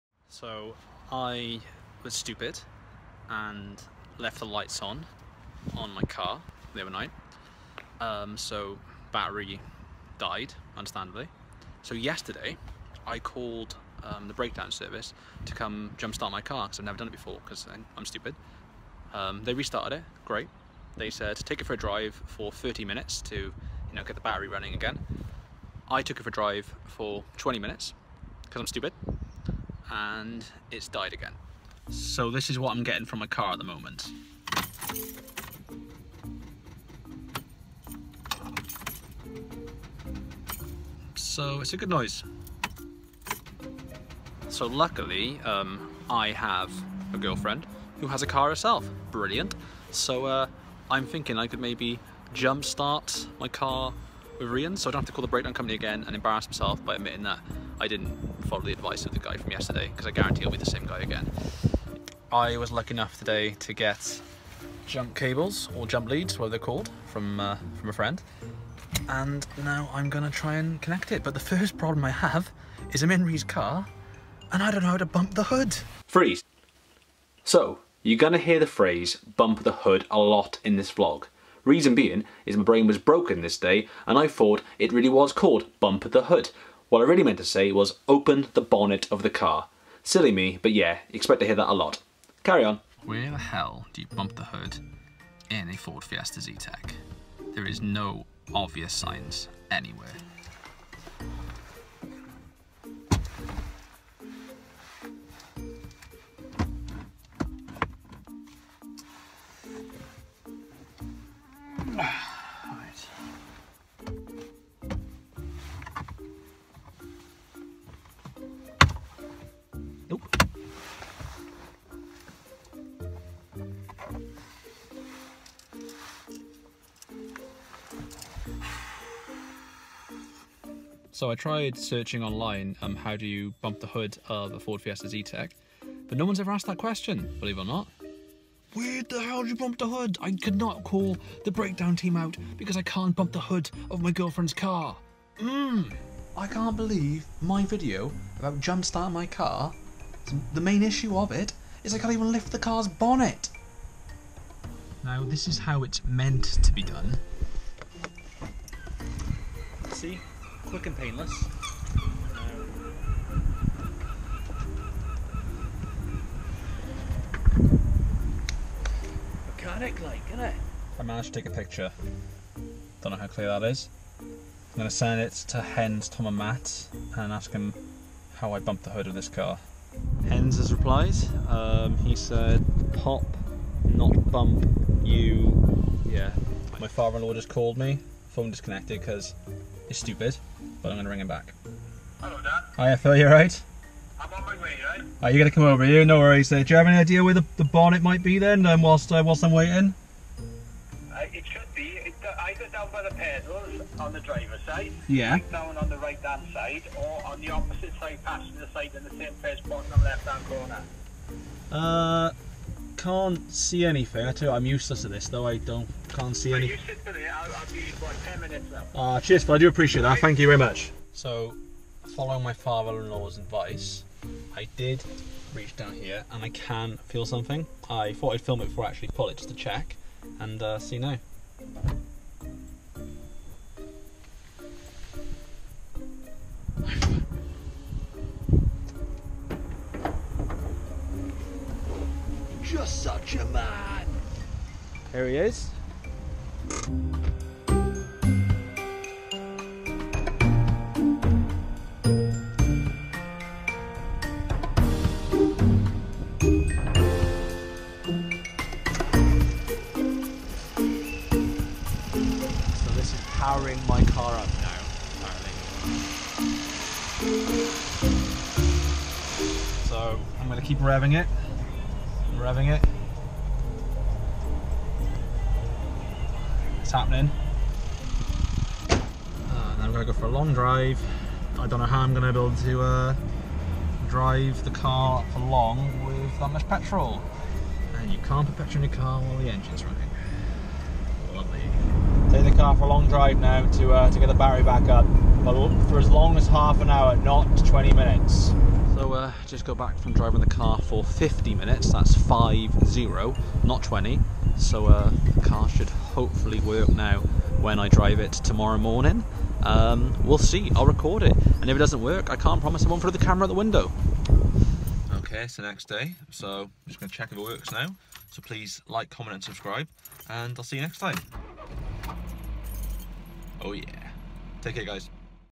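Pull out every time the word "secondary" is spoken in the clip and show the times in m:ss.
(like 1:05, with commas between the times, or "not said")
not said.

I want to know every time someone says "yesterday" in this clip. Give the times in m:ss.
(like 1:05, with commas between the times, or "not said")
0:11, 0:59.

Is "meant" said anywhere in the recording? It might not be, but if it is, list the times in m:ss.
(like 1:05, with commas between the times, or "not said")
1:27, 2:36.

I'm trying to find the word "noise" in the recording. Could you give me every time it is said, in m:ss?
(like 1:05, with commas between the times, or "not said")
0:41.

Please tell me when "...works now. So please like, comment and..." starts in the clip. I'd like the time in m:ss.
5:17.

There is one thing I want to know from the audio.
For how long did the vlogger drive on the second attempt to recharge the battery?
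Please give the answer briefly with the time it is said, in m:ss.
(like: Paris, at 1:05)
50 minutes, at 5:01.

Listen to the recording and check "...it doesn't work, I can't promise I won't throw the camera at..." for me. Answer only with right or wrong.
right.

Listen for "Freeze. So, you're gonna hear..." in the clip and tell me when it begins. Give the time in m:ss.
1:16.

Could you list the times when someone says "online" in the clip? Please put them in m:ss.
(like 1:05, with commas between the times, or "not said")
2:12.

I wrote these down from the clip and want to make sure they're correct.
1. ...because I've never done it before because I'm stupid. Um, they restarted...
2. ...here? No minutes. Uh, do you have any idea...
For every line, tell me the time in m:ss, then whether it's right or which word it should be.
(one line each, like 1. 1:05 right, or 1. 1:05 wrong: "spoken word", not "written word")
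1. 0:16 right
2. 3:15 wrong: "worries", not "minutes".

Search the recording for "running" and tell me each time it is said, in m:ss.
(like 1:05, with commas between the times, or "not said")
0:24, 4:49.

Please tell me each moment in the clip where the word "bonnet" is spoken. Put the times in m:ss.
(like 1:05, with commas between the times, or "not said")
1:28, 2:32, 3:17.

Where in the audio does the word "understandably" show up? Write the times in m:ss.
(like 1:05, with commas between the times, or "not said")
0:10.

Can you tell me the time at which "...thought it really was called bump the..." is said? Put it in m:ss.
1:24.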